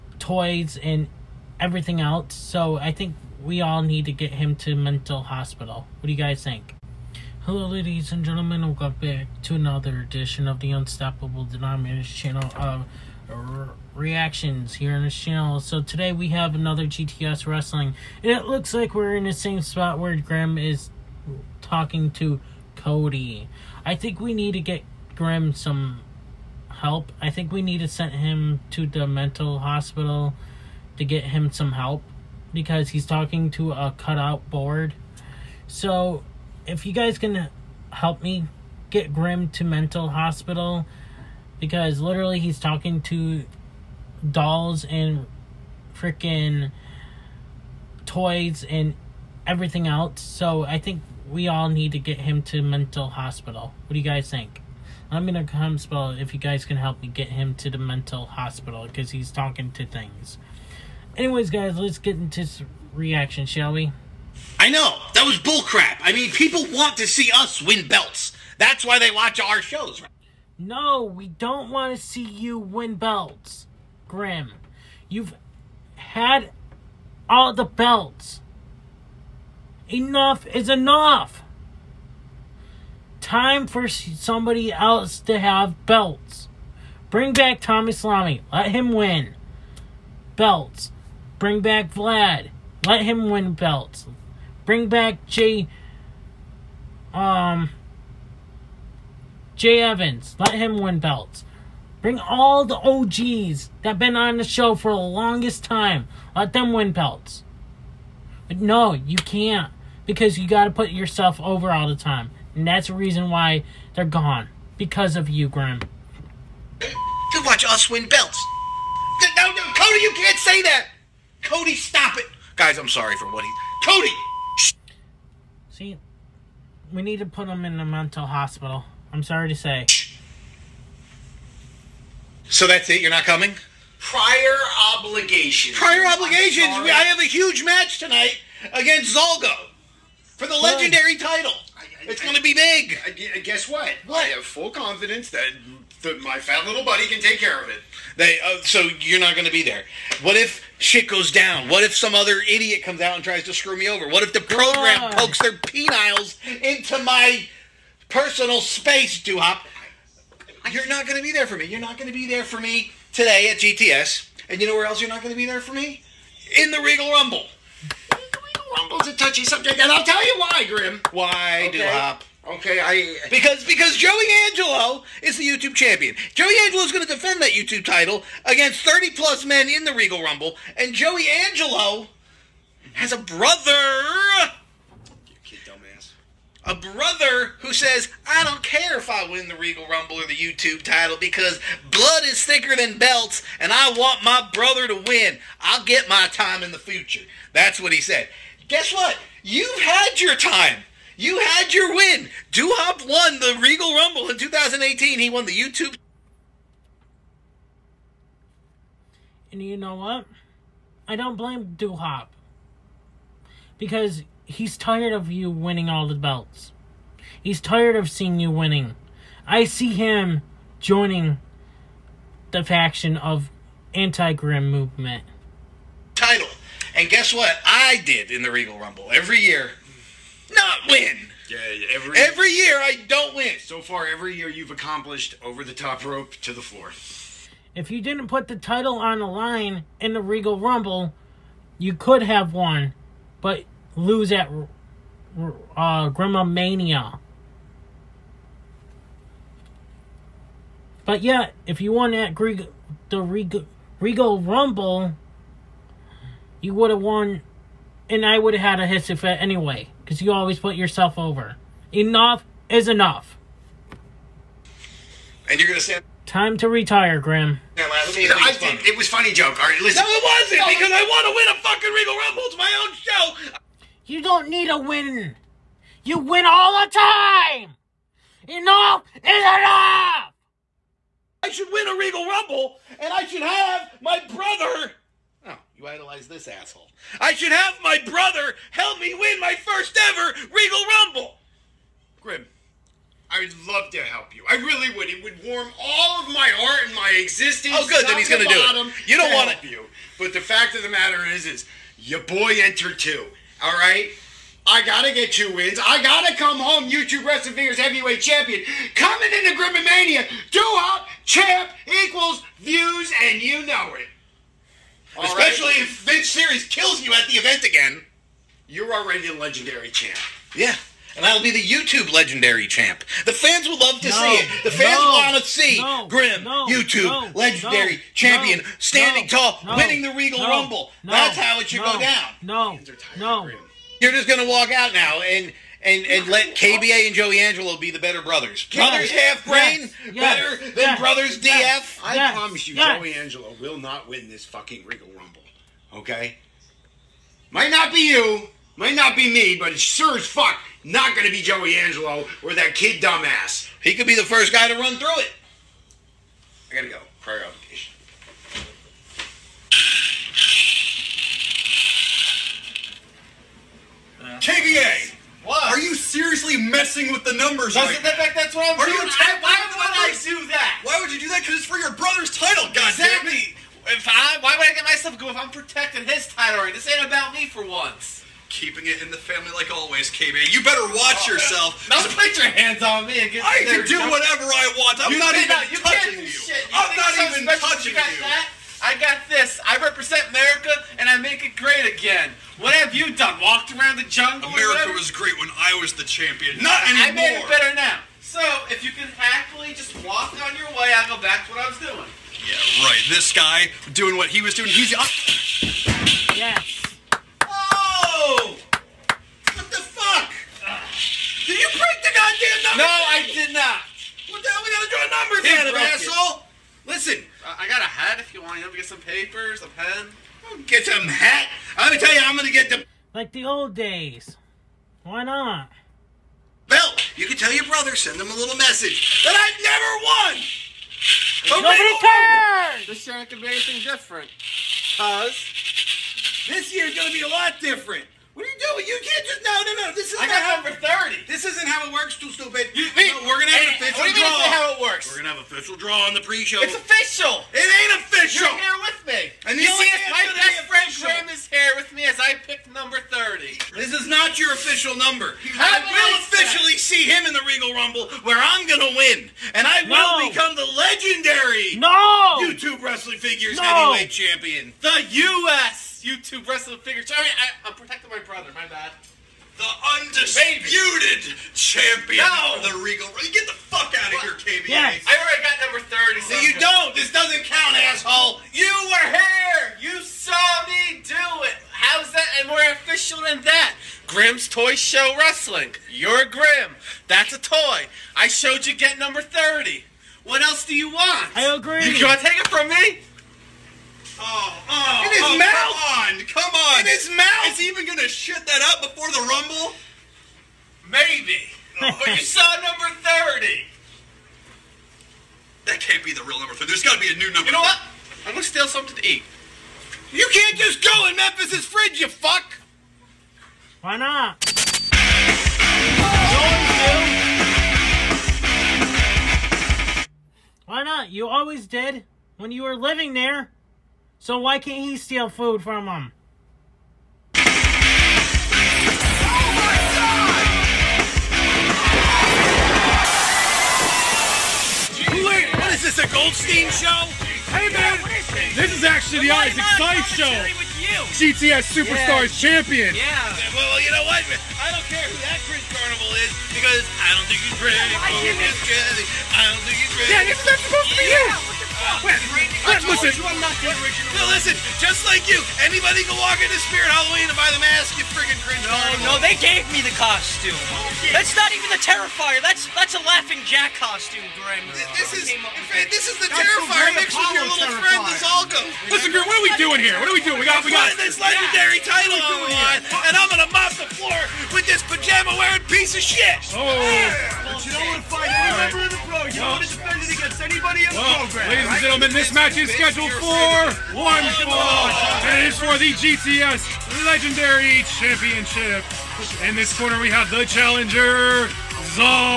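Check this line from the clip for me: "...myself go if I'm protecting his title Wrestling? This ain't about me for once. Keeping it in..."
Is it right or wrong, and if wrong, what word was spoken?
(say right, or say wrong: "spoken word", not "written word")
wrong: "Right", not "Wrestling".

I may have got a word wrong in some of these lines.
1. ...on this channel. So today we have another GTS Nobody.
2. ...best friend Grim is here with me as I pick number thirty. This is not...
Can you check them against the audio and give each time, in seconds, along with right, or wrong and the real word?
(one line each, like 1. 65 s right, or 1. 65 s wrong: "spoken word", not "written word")
1. 14 s wrong: "Wrestling", not "Nobody"
2. 450 s right.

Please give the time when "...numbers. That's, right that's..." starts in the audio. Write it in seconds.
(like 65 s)
367 s.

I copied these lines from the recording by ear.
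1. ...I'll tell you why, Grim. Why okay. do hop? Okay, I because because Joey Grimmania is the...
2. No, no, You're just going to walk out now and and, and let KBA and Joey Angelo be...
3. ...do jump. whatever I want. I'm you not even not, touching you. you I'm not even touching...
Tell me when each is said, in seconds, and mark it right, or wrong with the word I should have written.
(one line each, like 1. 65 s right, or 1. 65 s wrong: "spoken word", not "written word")
1. 169 s wrong: "Angelo", not "Grimmania"
2. 332 s right
3. 383 s right.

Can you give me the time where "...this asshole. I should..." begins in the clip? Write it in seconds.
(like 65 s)
286 s.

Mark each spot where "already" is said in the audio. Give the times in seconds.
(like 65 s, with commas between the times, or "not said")
318 s, 475 s.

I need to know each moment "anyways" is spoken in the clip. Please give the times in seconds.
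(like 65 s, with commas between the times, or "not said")
61 s, 259 s.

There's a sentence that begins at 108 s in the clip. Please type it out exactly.
But no, you can't because you got to put yourself over all the time.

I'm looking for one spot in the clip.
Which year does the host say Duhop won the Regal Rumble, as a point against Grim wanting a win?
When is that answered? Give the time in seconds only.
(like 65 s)
204 s.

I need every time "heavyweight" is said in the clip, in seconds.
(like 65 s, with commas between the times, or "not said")
307 s, 463 s.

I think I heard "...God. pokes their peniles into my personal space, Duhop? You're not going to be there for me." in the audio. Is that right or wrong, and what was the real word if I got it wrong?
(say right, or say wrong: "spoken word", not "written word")
right.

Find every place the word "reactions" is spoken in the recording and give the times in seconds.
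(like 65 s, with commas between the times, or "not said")
13 s, 62 s.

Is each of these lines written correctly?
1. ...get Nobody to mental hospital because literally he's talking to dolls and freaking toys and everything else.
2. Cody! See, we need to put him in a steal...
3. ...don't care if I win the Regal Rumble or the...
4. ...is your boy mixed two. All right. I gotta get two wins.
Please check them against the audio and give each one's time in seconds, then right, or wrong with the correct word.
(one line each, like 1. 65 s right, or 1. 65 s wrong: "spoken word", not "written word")
1. 38 s wrong: "Grim", not "Nobody"
2. 123 s wrong: "mental", not "steal"
3. 188 s right
4. 301 s wrong: "entered", not "mixed".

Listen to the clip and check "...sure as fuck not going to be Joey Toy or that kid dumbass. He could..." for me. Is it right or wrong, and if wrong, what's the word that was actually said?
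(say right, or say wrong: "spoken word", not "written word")
wrong: "Angelo", not "Toy".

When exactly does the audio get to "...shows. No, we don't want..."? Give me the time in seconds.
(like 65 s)
69 s.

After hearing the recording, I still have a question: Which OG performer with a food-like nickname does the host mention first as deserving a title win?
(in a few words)
Tommy Salami.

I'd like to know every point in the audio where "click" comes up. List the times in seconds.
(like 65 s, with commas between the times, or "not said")
not said.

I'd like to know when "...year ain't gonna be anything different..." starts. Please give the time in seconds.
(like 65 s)
433 s.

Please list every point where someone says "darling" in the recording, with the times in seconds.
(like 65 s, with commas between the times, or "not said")
not said.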